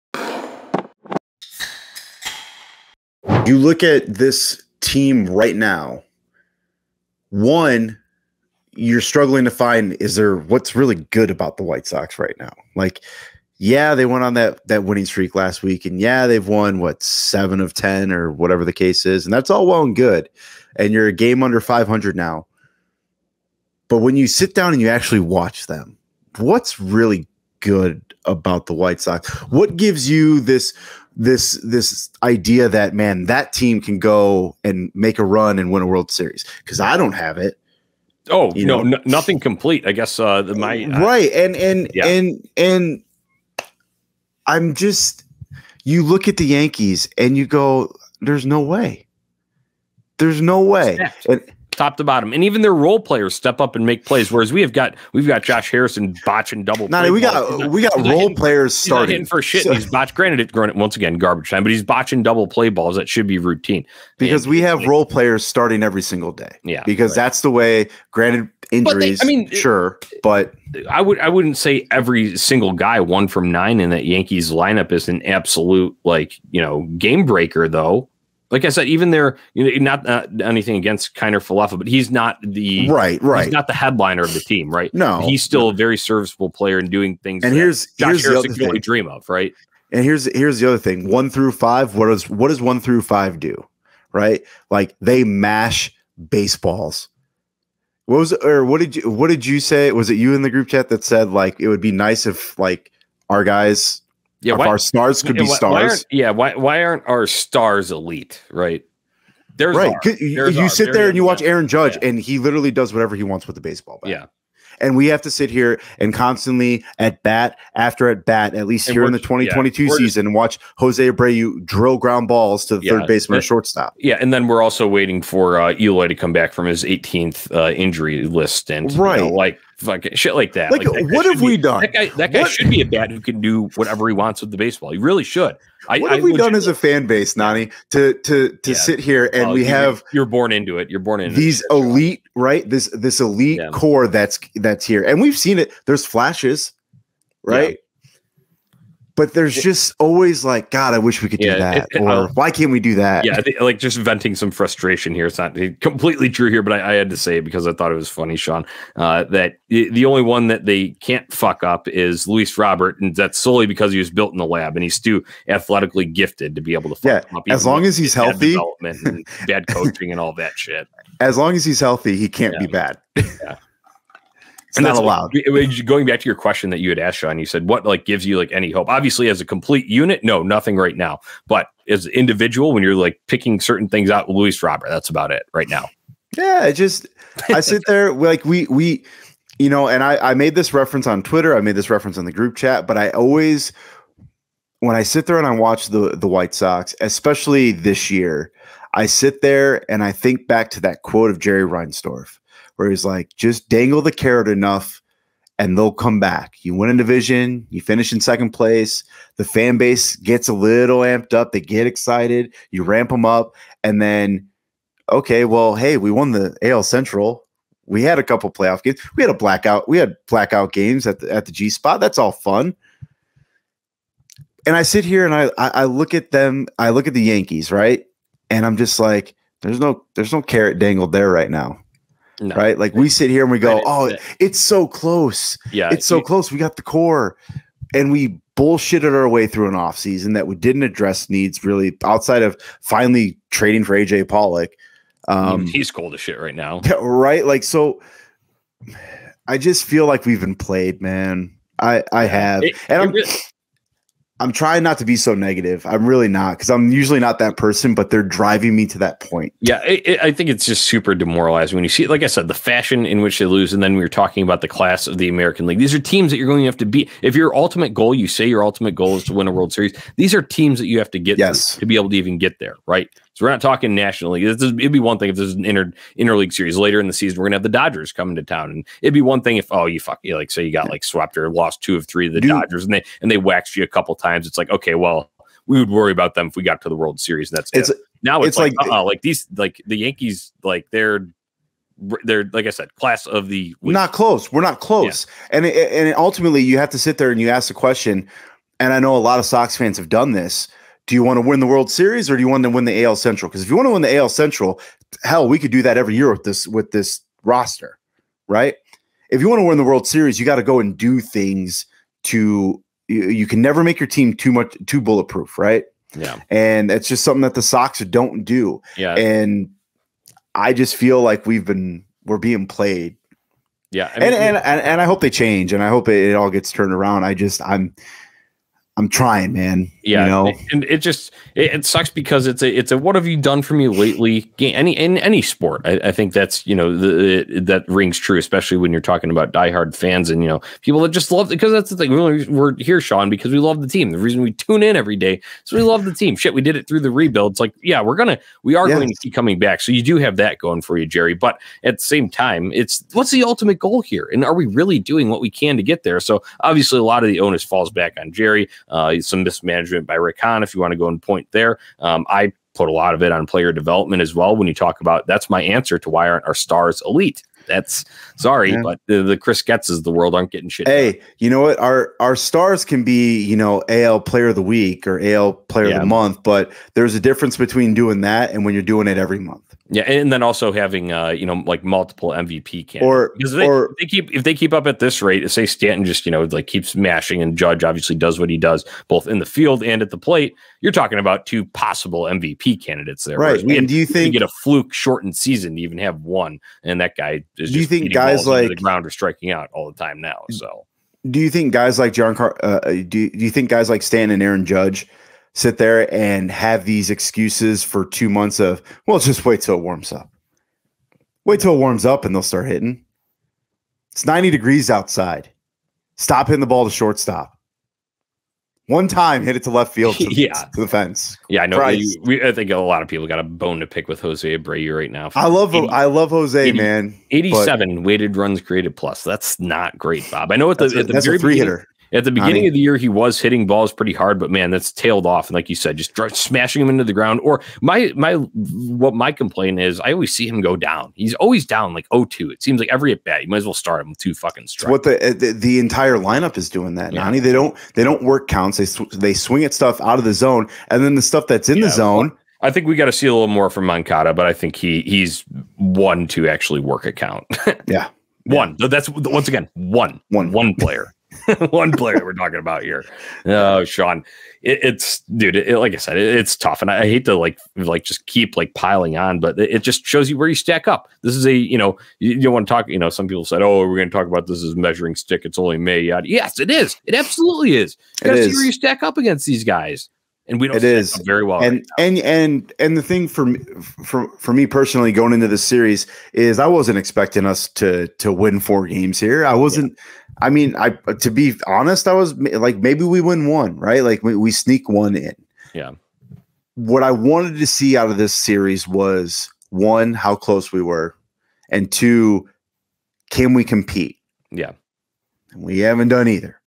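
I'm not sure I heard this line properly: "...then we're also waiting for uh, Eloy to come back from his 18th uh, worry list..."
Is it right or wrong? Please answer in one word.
wrong.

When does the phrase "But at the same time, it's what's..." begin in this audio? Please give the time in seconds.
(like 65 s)
351 s.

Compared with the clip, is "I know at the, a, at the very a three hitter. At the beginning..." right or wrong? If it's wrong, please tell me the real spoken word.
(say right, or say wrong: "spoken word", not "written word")
right.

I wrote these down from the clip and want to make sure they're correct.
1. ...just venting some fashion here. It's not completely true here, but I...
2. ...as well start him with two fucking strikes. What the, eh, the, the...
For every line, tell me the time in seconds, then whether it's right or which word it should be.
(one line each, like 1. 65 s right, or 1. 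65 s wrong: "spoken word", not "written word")
1. 153 s wrong: "frustration", not "fashion"
2. 443 s right.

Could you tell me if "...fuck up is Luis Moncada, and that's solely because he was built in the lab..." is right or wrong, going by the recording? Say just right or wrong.
wrong.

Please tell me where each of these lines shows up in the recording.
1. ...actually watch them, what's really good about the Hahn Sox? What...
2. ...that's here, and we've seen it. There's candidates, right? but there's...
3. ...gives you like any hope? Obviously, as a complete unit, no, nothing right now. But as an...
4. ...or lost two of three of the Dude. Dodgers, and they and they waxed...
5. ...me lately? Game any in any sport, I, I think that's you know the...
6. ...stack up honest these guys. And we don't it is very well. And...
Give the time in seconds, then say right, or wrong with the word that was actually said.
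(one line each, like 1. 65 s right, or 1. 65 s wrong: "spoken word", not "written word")
1. 24 s wrong: "White", not "Hahn"
2. 144 s wrong: "flashes", not "candidates"
3. 178 s right
4. 281 s right
5. 333 s right
6. 478 s wrong: "against", not "honest".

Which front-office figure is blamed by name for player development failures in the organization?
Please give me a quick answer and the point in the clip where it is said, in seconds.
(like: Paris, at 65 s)
Chris Getz, at 369 s.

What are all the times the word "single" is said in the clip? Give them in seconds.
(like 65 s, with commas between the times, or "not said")
66 s, 72 s.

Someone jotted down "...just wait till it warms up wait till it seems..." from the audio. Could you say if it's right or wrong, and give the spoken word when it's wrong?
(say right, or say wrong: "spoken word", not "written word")
wrong: "warms", not "seems".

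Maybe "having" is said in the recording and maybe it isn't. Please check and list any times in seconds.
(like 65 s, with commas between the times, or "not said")
380 s.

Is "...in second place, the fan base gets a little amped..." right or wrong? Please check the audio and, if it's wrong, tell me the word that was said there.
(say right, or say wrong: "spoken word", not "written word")
right.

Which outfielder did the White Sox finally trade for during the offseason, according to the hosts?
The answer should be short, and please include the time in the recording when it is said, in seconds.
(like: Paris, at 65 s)
AJ Pollock, at 243 s.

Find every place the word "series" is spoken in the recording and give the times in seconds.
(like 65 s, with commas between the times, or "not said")
36 s, 269 s, 276 s, 287 s, 301 s, 310 s, 485 s, 498 s.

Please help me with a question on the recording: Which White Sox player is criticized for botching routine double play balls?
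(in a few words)
Josh Harrison.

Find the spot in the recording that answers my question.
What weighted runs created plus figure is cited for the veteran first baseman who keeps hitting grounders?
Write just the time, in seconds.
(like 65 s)
427 s.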